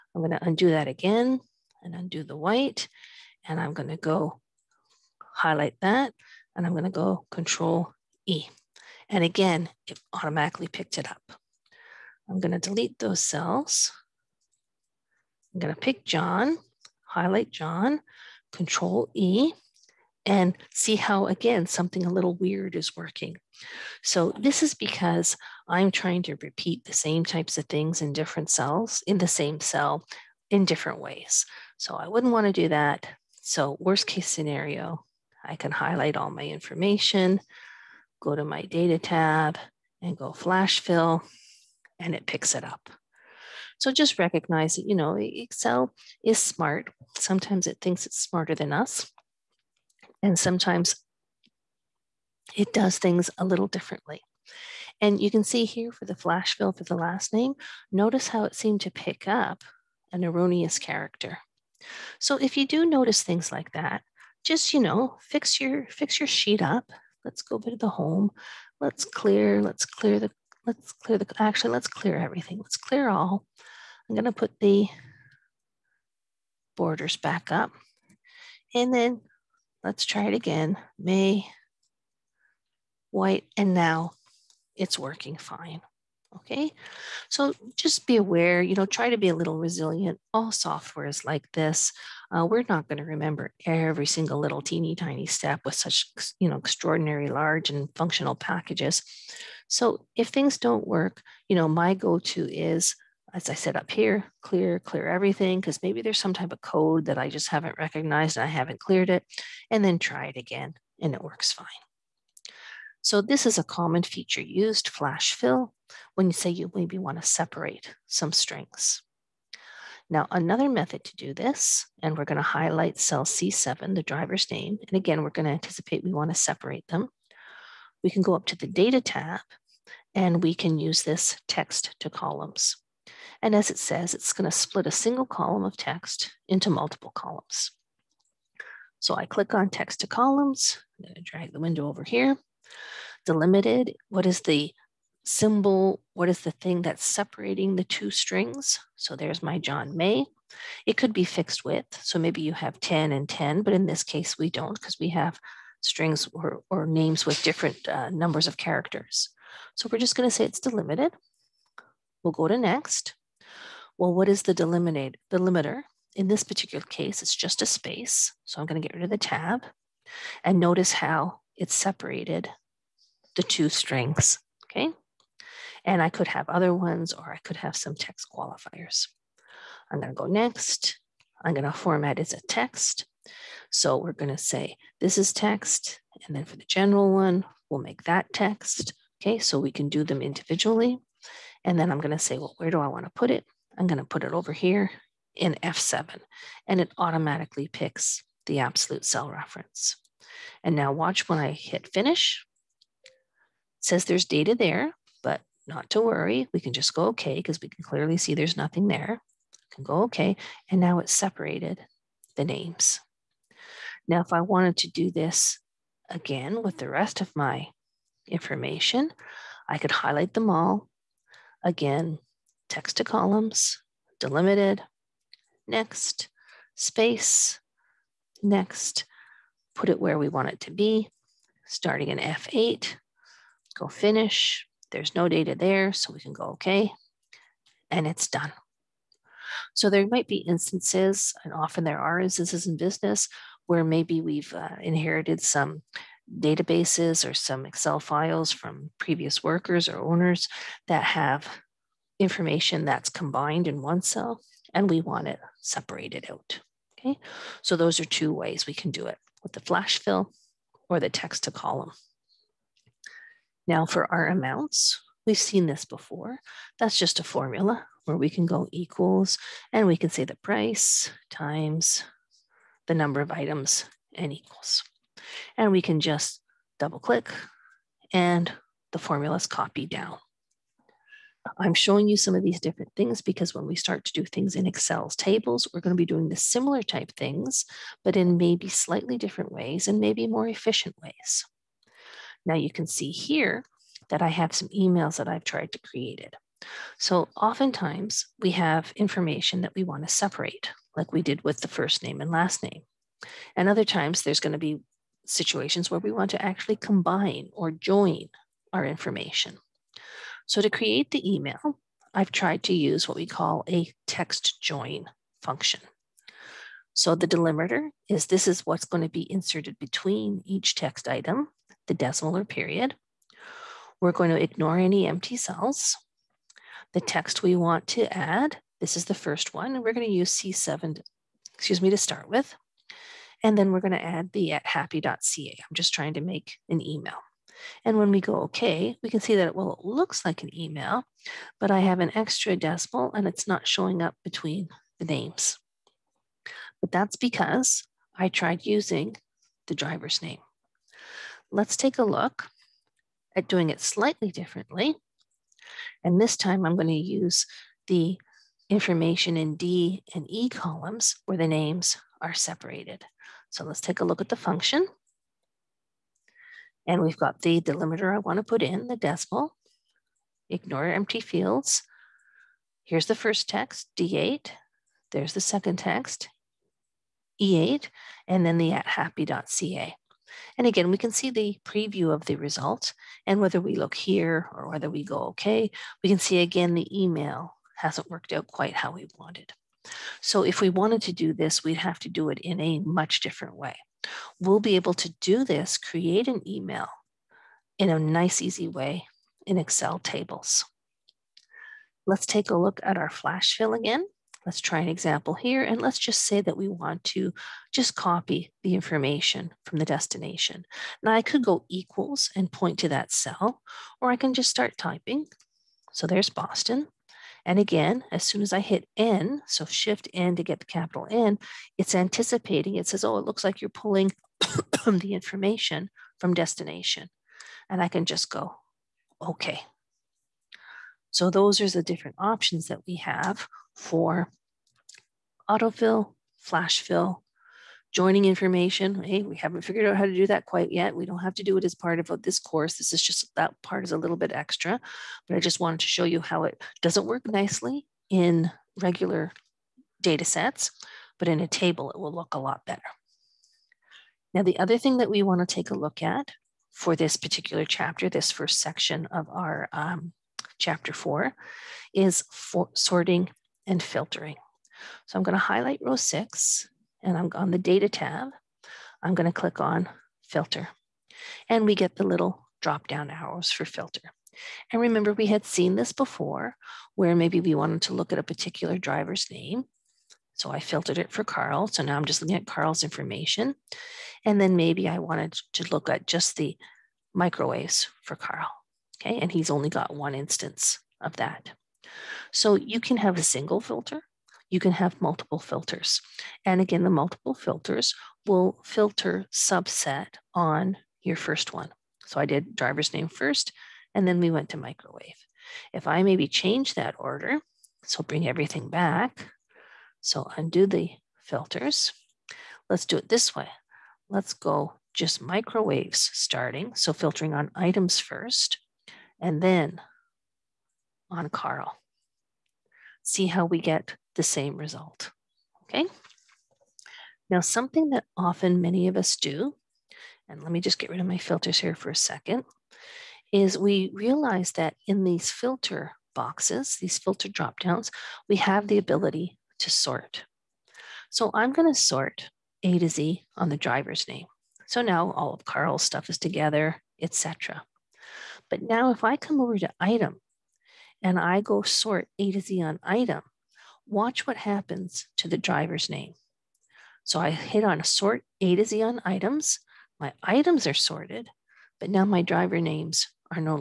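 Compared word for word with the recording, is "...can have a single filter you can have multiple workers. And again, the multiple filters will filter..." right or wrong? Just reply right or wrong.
wrong.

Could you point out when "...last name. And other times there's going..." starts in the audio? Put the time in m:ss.
5:02.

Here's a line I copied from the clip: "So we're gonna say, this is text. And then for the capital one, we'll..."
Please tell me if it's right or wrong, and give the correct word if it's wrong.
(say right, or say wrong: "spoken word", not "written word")
wrong: "general", not "capital".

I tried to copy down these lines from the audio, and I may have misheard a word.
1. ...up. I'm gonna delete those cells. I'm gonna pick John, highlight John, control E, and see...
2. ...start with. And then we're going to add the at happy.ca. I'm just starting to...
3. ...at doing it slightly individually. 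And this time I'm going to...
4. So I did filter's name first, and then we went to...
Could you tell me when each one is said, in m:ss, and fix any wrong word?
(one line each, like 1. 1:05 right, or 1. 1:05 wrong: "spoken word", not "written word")
1. 0:11 right
2. 5:31 wrong: "trying", not "starting"
3. 5:53 wrong: "differently", not "individually"
4. 8:22 wrong: "driver", not "filter".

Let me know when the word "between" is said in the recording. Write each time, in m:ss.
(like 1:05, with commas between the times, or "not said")
5:19, 5:44.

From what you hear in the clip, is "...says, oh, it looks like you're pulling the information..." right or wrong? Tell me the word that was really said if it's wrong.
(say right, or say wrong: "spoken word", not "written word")
right.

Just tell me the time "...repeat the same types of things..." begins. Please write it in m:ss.
0:26.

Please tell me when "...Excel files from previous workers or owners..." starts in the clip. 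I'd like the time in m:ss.
4:07.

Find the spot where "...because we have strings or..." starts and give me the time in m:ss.
2:34.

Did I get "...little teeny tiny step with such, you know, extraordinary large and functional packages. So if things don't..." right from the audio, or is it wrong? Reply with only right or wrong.
right.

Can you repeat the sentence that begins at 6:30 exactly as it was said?
So if we wanted to do this, we'd have to do it in a much different way.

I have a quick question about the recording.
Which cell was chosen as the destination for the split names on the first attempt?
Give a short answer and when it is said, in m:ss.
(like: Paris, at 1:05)
F7, at 3:15.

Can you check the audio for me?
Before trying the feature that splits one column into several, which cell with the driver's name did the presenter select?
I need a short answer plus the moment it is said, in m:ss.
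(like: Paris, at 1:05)
C7, at 2:02.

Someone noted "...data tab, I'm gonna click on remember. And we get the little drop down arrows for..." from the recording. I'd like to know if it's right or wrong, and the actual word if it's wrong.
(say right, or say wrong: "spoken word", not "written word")
wrong: "filter", not "remember".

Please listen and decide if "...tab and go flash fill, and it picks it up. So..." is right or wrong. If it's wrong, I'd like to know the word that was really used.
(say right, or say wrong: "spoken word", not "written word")
right.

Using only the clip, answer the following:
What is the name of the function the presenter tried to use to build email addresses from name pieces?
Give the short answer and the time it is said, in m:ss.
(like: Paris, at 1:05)
text join, at 5:14.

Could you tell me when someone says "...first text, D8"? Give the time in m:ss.
6:13.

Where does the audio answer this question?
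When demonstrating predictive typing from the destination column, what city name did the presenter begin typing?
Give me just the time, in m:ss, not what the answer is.
6:56.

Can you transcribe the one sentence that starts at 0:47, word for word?
Sometimes it thinks it's smarter than us.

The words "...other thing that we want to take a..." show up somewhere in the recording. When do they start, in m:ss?
7:34.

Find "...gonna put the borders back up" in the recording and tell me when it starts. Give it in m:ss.
1:14.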